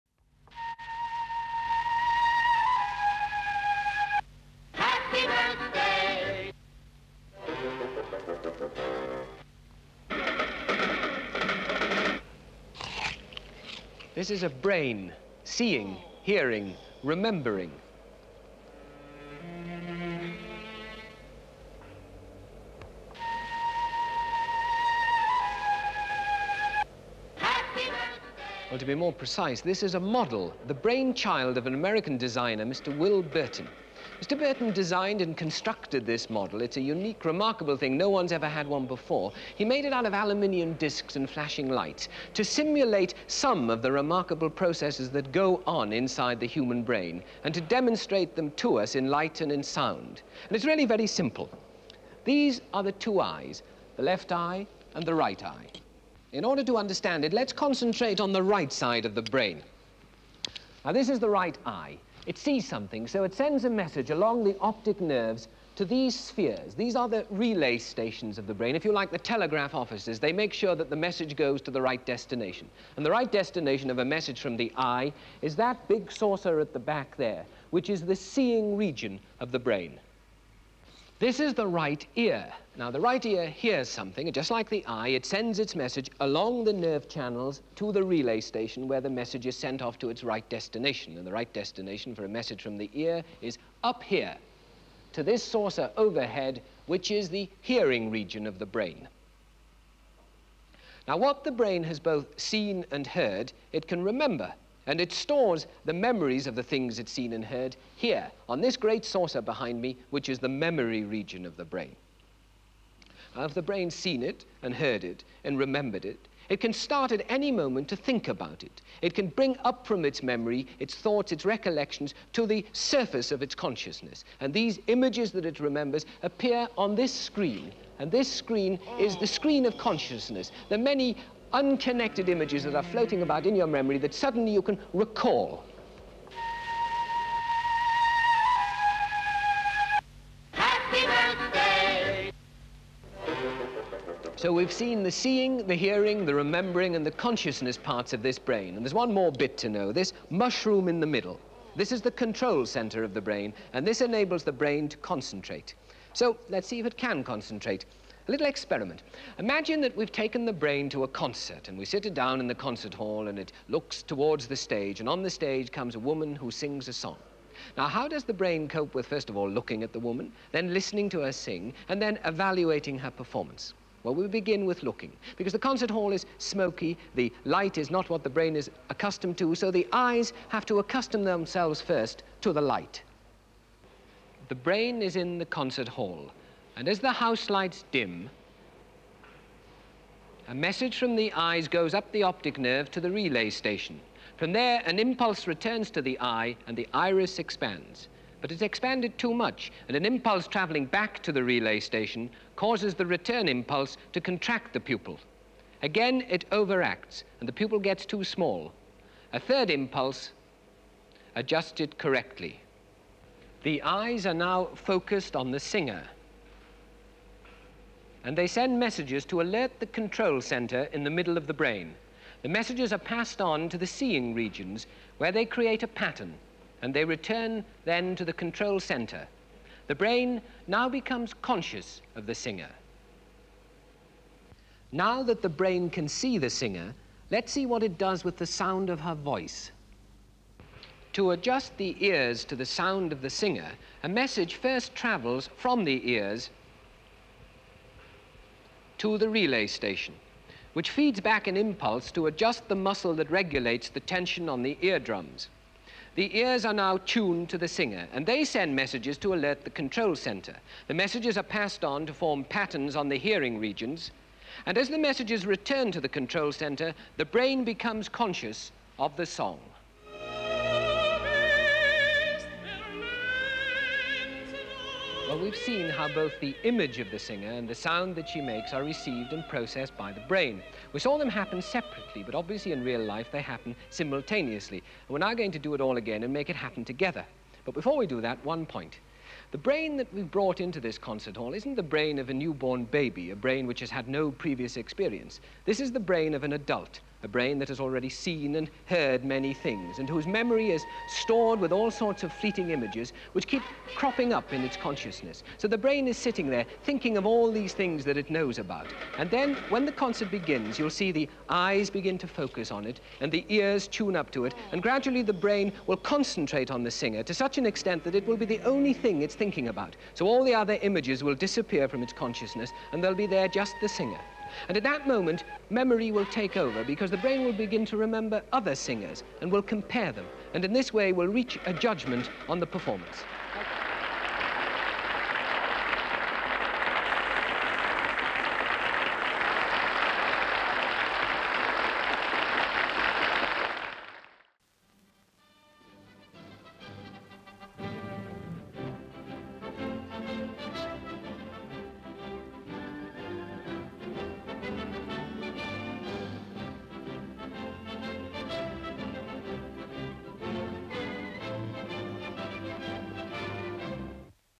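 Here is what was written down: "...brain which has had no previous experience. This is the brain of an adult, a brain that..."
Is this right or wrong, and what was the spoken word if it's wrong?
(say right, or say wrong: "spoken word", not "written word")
right.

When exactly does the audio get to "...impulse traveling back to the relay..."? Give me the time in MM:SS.
03:20.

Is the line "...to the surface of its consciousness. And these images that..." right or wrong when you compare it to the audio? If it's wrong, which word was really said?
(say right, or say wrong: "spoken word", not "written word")
right.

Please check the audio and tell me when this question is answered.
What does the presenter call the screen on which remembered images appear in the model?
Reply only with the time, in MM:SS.
02:09.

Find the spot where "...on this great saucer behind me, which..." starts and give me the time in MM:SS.
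01:48.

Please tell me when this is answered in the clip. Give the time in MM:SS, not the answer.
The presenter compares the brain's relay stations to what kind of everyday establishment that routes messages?
01:09.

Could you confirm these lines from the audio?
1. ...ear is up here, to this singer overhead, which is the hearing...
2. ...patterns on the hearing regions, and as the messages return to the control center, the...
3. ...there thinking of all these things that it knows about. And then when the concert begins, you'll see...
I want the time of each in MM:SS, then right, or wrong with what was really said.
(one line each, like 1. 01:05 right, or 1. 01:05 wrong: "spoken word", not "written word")
1. 01:32 wrong: "saucer", not "singer"
2. 04:22 right
3. 05:06 right.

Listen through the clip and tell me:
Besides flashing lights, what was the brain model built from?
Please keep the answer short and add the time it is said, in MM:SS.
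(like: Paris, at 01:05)
aluminium discs, at 00:40.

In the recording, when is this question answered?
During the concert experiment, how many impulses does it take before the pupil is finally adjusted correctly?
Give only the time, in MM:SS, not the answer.
03:29.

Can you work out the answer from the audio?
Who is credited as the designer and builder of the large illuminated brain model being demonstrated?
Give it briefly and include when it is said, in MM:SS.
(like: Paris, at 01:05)
Will Burtin, at 00:32.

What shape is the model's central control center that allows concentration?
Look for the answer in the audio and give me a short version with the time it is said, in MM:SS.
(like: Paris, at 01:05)
mushroom, at 02:30.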